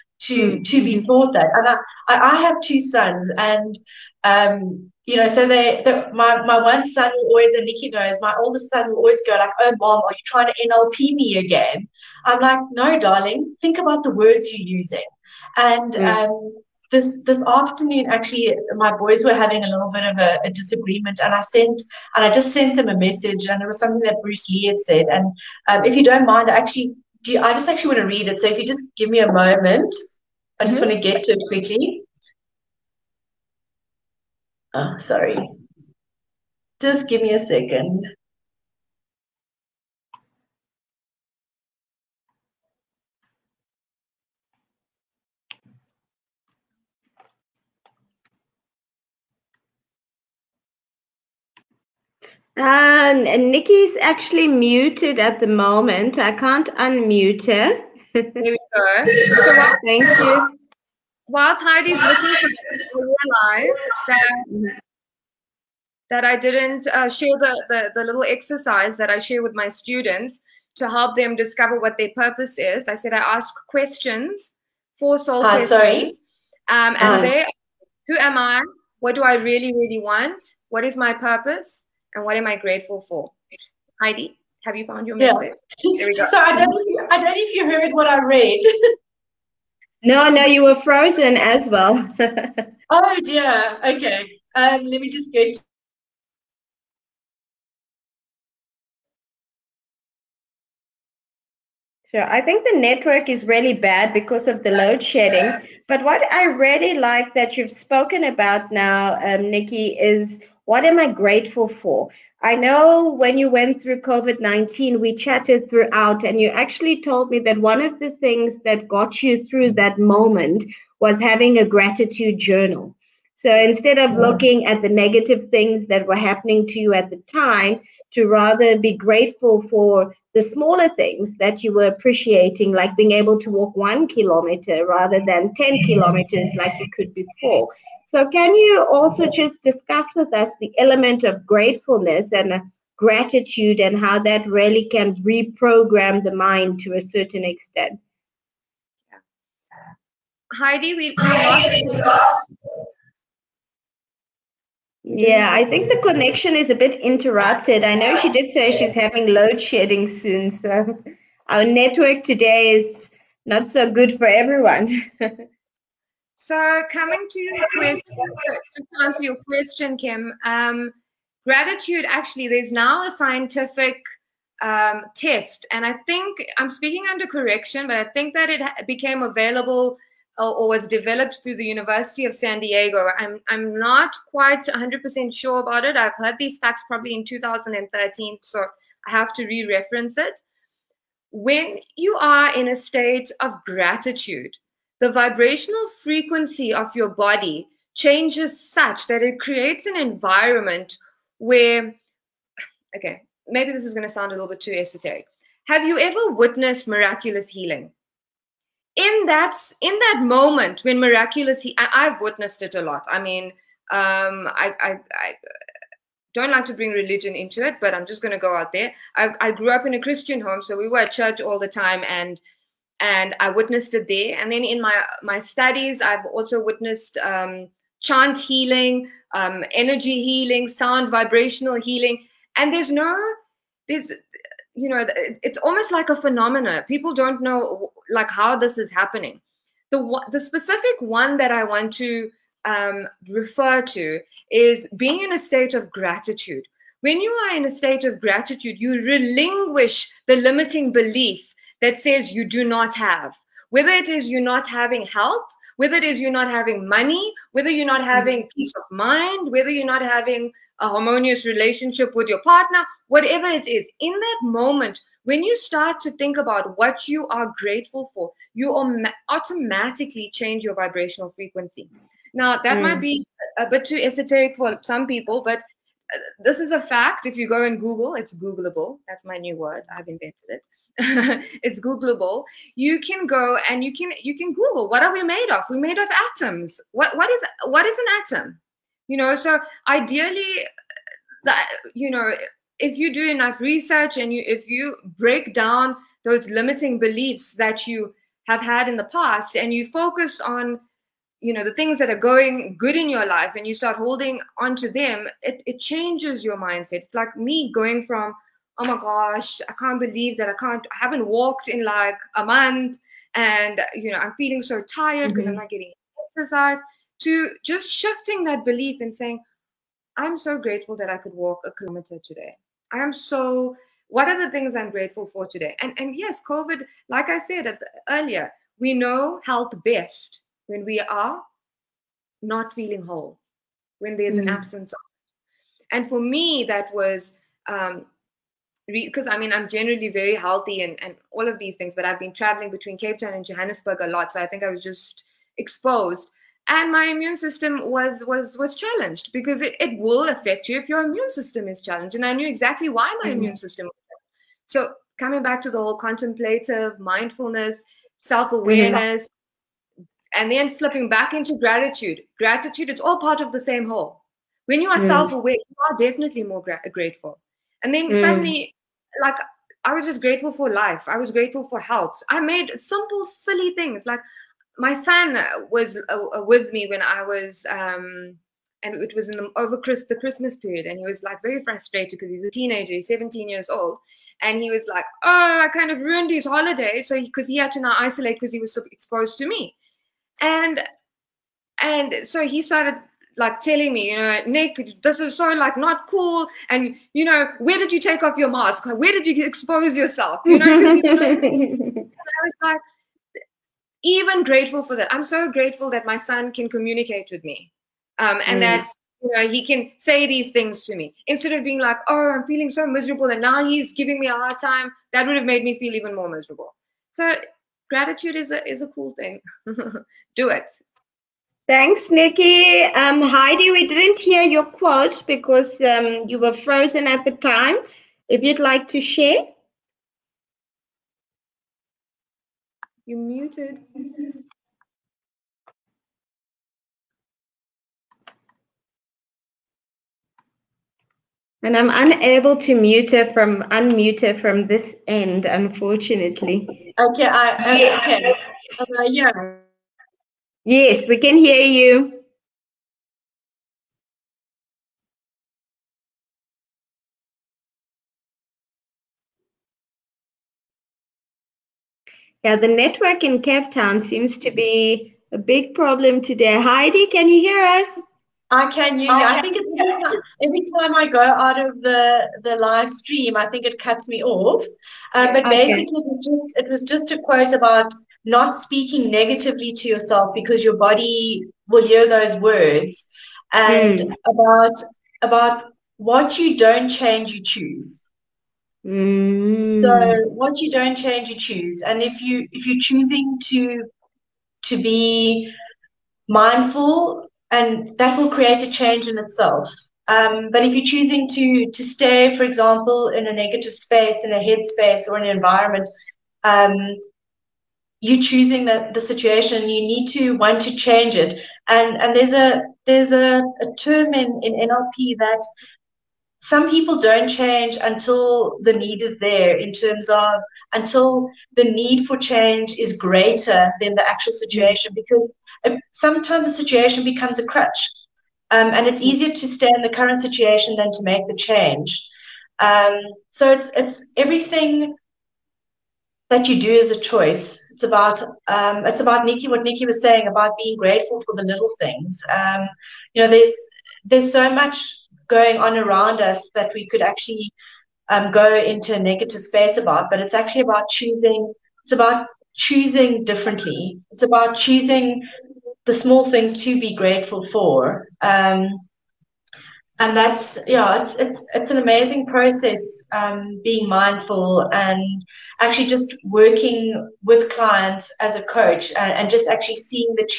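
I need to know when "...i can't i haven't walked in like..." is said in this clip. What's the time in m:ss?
5:10.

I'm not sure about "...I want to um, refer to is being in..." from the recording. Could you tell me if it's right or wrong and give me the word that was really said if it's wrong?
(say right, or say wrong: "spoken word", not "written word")
right.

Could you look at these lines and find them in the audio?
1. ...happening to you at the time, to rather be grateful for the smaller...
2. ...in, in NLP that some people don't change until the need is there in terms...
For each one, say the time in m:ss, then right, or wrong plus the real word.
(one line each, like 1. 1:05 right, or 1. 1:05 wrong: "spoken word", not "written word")
1. 2:06 right
2. 8:34 right.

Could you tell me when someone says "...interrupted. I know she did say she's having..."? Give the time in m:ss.
2:36.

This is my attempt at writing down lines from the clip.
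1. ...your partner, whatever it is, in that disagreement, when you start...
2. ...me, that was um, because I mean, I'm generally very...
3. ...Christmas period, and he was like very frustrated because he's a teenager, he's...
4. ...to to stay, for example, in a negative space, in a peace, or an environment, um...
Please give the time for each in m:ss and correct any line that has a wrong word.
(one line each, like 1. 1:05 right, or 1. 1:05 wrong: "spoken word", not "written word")
1. 4:22 wrong: "moment", not "disagreement"
2. 5:36 right
3. 6:20 right
4. 8:21 wrong: "headspace", not "peace".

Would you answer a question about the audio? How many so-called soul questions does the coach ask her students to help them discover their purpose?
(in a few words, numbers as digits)
4.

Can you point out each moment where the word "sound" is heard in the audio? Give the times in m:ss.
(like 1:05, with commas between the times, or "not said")
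3:24, 3:50.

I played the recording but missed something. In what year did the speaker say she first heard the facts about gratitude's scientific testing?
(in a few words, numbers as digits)
2013.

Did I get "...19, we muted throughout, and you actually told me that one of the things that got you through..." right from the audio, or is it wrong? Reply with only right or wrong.
wrong.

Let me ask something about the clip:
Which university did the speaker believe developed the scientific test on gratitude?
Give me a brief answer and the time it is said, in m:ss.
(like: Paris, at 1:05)
University of San Diego, at 3:02.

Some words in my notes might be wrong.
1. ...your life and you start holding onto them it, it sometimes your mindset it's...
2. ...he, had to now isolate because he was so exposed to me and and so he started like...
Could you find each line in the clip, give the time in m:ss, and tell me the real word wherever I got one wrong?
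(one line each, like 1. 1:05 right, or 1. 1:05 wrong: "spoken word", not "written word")
1. 5:03 wrong: "changes", not "sometimes"
2. 6:27 right.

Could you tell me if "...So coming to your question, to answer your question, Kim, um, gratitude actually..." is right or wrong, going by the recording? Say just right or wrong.
right.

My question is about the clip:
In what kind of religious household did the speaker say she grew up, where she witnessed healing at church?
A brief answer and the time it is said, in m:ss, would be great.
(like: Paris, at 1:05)
Christian, at 3:39.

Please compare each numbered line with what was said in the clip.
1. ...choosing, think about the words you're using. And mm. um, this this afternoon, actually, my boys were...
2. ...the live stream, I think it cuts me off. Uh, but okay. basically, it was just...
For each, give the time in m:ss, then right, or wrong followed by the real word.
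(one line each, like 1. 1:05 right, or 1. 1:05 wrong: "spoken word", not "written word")
1. 0:12 wrong: "darling", not "choosing"
2. 7:52 right.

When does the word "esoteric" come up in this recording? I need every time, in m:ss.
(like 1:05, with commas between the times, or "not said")
3:24, 4:33.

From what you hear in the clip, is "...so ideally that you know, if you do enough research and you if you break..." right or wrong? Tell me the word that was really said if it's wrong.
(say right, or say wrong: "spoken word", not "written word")
right.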